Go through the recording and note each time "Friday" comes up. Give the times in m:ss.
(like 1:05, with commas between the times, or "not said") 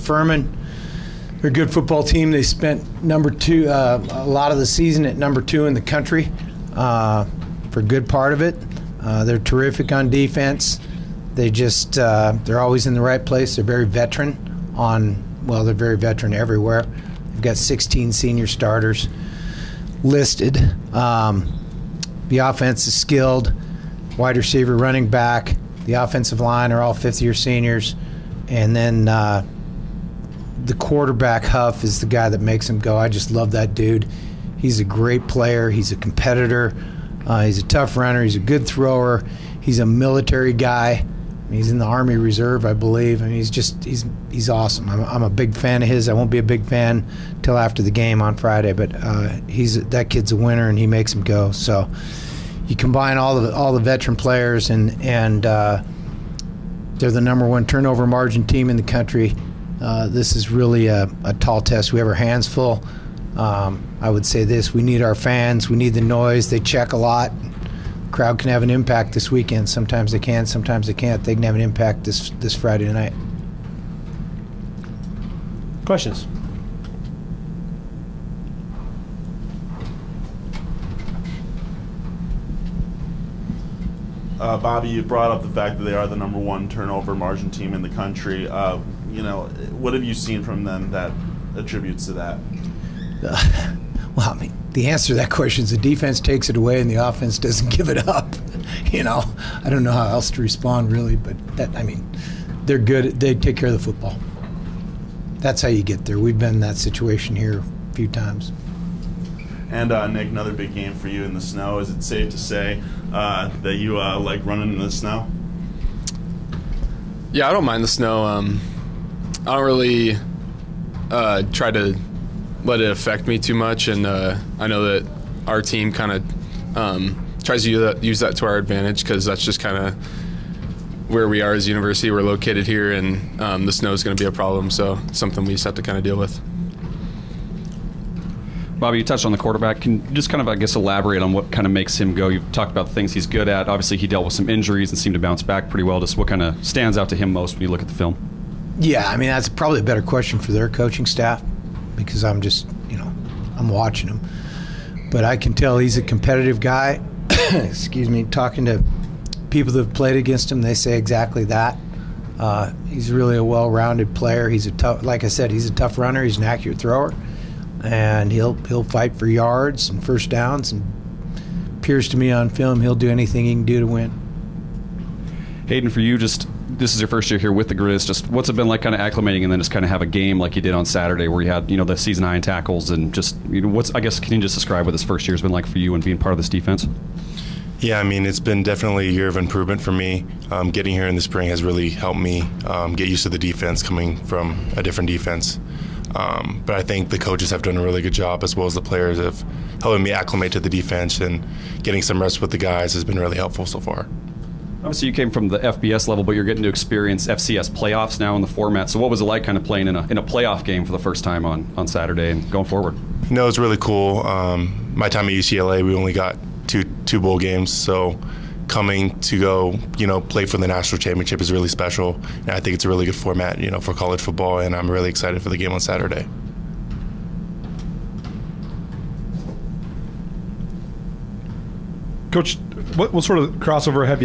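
0:48, 1:12.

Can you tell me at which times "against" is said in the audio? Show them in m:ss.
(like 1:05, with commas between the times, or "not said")
2:40.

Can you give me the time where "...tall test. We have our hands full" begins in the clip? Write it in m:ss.
1:01.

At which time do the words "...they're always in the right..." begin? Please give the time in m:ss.
0:12.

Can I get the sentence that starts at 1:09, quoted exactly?
Sometimes they can, sometimes they can't.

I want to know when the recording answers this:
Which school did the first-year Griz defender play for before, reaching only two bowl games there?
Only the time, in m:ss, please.
3:35.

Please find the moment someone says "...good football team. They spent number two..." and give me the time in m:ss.
0:01.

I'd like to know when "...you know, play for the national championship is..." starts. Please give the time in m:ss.
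3:39.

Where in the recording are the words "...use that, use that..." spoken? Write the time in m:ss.
2:07.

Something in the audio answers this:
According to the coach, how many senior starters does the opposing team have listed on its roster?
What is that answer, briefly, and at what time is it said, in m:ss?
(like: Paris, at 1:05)
16, at 0:17.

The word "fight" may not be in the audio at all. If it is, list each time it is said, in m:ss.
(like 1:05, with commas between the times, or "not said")
2:48.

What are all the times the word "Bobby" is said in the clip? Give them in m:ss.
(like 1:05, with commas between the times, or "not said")
1:24, 2:18.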